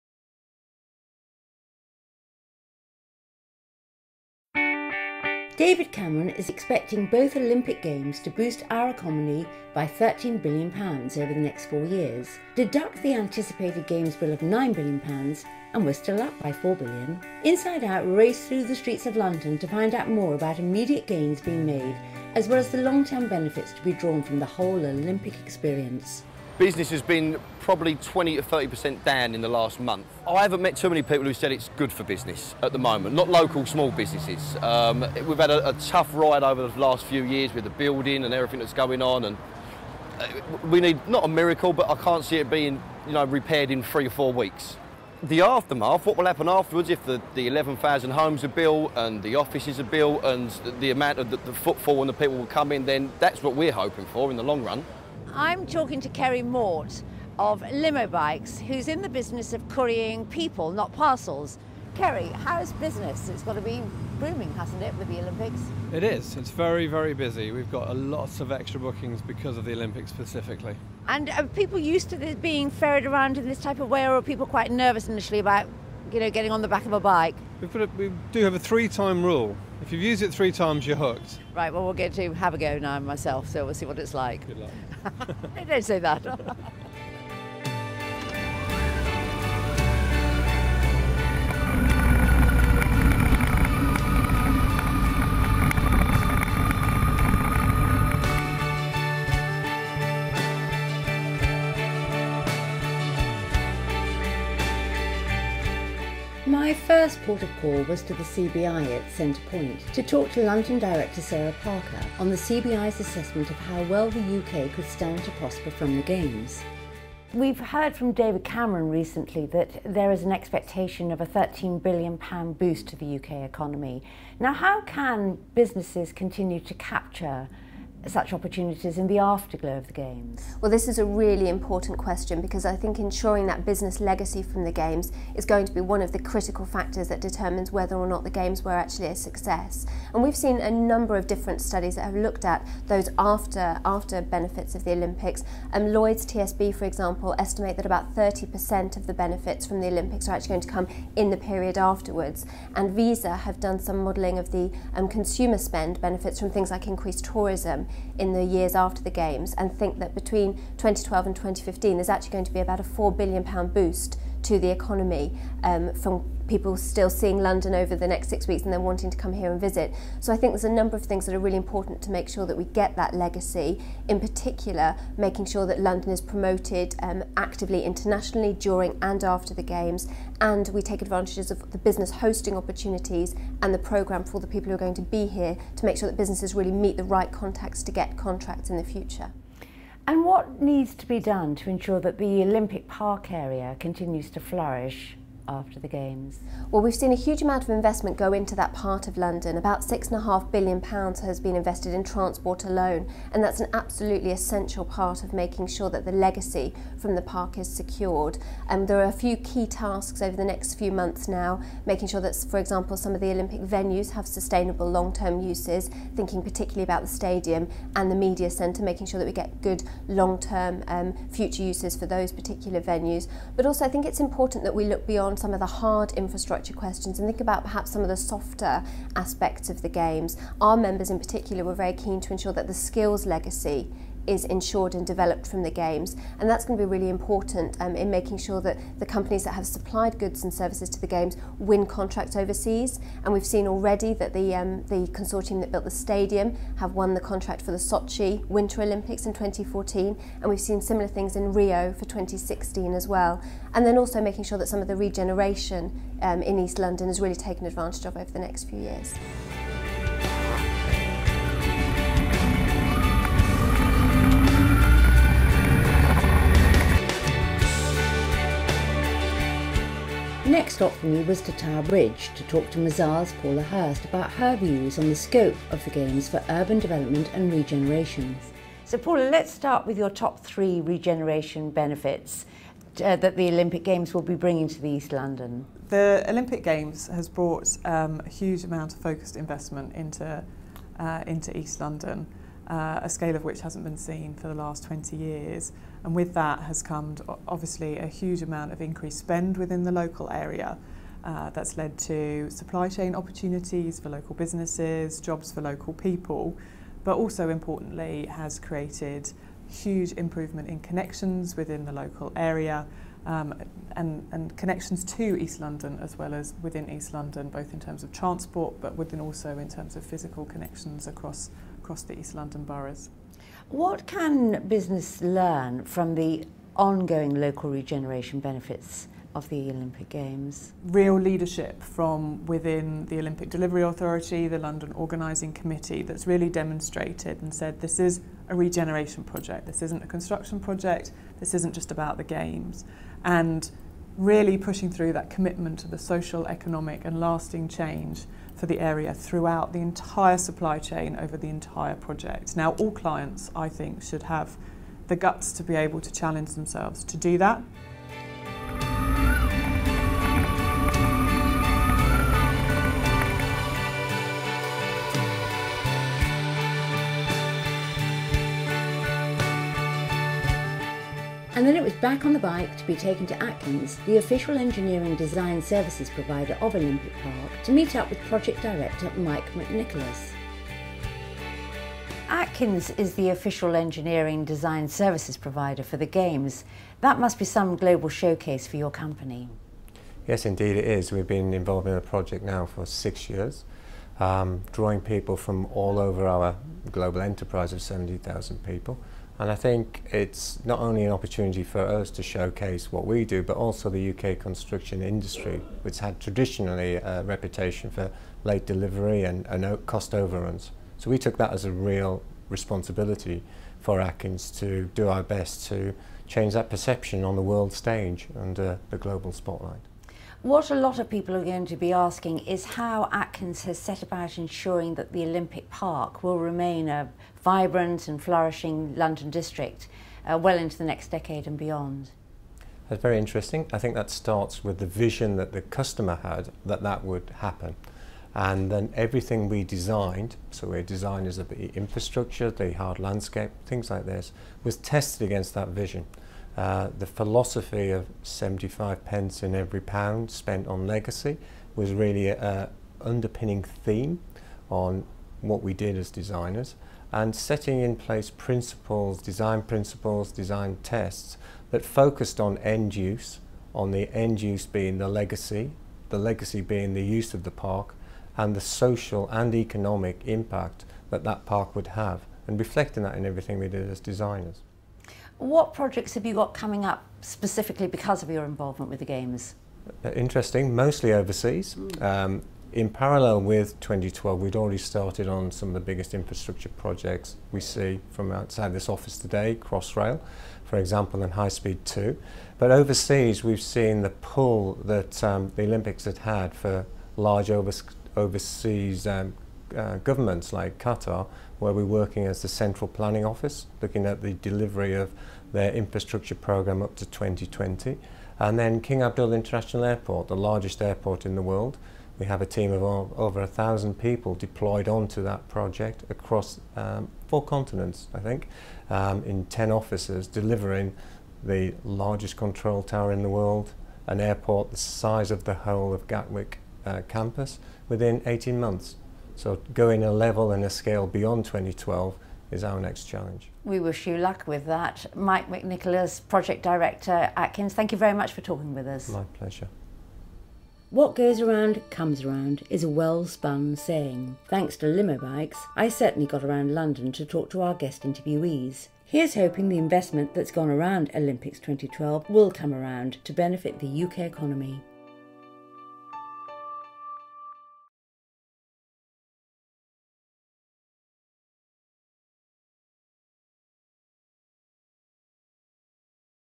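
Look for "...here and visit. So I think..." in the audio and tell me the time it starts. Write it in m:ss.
2:49.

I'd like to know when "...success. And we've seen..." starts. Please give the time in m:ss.
2:19.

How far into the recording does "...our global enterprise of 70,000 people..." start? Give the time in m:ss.
6:36.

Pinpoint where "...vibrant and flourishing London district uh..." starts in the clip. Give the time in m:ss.
7:07.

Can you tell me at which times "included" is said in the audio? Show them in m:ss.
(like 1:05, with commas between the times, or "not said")
not said.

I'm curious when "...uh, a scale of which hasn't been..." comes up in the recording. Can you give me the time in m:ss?
4:52.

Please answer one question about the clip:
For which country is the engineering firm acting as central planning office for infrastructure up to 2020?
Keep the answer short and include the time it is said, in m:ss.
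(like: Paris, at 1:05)
Qatar, at 8:20.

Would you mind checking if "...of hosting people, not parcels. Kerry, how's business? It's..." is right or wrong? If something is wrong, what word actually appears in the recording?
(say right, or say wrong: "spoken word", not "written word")
wrong: "currying", not "hosting".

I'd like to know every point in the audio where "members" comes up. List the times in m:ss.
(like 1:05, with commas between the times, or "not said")
3:50.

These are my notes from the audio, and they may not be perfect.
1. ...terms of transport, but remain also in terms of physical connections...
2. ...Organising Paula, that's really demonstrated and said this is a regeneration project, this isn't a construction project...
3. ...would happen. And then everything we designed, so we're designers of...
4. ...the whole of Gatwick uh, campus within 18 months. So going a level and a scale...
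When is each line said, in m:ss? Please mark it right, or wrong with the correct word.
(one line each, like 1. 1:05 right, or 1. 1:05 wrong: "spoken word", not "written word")
1. 5:17 wrong: "within", not "remain"
2. 5:34 wrong: "Committee", not "Paula"
3. 7:17 right
4. 8:45 right.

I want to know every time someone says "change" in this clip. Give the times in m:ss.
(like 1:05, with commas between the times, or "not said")
5:47, 6:56.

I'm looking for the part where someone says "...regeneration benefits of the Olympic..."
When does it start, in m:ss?
5:27.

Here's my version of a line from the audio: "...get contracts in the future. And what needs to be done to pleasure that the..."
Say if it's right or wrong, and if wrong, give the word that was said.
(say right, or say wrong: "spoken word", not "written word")
wrong: "ensure", not "pleasure".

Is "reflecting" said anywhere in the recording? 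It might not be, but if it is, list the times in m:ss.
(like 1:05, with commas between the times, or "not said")
7:52.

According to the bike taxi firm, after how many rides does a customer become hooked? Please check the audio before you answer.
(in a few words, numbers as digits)
3.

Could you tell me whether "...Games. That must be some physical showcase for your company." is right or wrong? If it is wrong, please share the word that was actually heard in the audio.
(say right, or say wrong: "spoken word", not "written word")
wrong: "global", not "physical".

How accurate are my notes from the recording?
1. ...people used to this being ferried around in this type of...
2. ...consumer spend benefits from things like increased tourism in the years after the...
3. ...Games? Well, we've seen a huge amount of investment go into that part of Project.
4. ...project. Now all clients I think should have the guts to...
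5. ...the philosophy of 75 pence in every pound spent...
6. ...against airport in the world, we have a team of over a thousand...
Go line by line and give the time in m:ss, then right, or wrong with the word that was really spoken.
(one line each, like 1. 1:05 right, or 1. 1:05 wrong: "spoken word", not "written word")
1. 1:11 right
2. 2:35 right
3. 3:15 wrong: "London", not "Project"
4. 5:51 right
5. 7:26 right
6. 8:30 wrong: "largest", not "against".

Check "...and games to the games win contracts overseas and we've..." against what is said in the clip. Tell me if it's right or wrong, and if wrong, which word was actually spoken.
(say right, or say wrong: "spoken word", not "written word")
wrong: "services", not "games".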